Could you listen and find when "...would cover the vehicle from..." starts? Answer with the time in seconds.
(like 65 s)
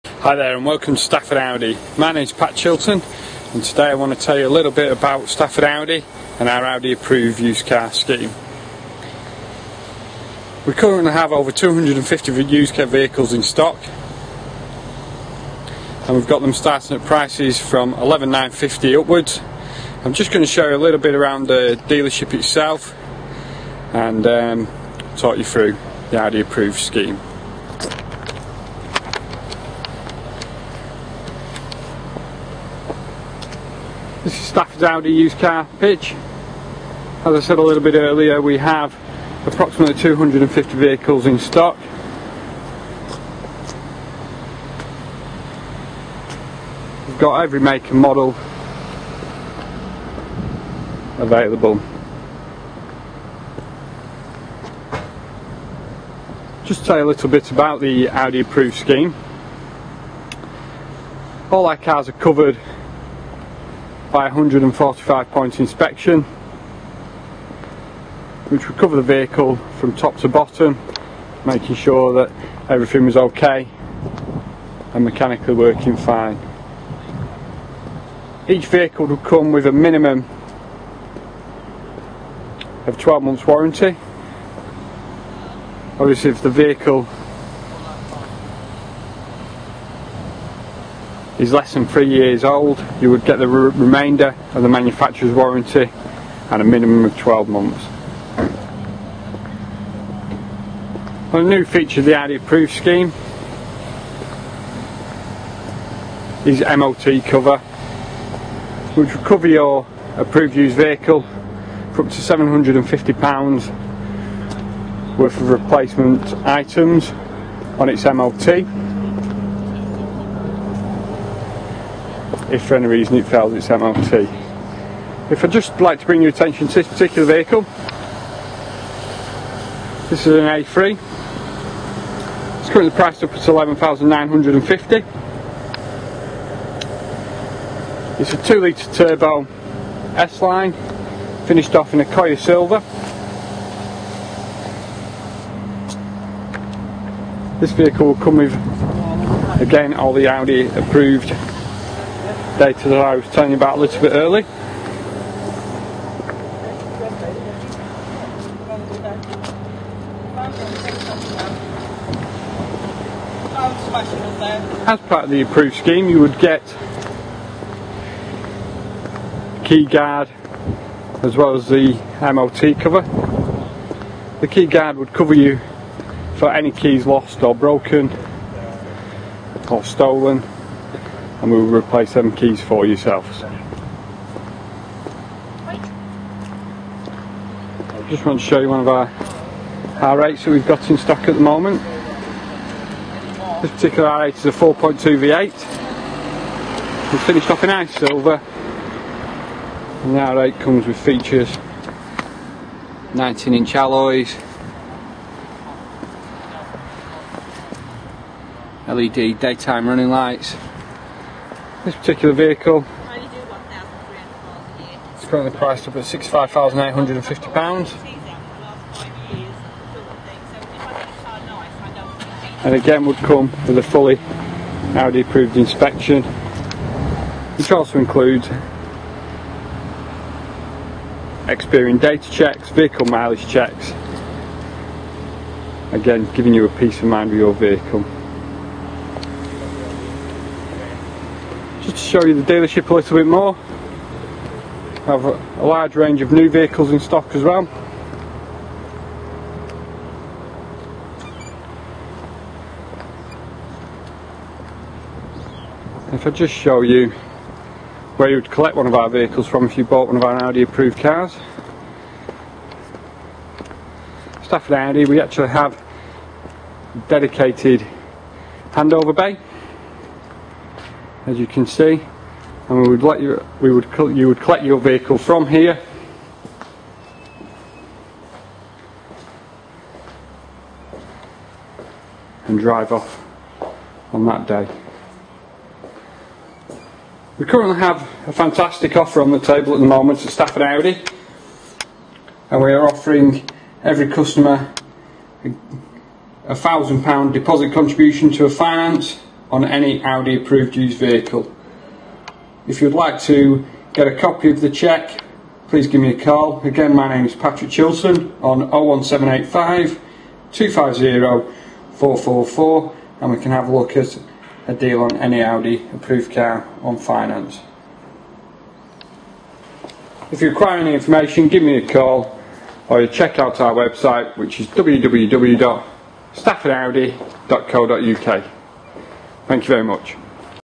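68 s.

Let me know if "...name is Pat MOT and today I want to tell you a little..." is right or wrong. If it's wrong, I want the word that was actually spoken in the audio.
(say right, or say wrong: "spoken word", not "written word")
wrong: "Chilton", not "MOT".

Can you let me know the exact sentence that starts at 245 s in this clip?
I have a large range of new vehicles in stock as well.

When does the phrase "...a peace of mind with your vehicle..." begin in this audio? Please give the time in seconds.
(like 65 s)
236 s.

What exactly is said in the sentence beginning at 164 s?
As part of the approved scheme you would get key guard as well as the MOT cover.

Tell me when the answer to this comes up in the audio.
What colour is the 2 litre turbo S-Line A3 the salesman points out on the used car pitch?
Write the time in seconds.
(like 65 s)
142 s.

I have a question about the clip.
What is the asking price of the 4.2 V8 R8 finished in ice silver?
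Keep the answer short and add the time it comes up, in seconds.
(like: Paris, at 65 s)
£65,850, at 216 s.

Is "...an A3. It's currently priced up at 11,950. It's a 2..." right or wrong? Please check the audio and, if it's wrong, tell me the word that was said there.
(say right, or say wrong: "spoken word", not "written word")
right.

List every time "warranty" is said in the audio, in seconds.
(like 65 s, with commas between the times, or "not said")
83 s, 95 s.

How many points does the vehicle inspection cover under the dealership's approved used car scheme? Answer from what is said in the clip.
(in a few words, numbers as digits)
145.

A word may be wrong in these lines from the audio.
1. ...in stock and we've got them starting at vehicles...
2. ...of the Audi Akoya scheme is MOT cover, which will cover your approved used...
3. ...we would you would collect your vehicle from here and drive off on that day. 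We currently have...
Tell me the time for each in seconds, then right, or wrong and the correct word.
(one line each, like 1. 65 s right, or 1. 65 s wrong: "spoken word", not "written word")
1. 13 s wrong: "prices", not "vehicles"
2. 102 s wrong: "Approved", not "Akoya"
3. 273 s right.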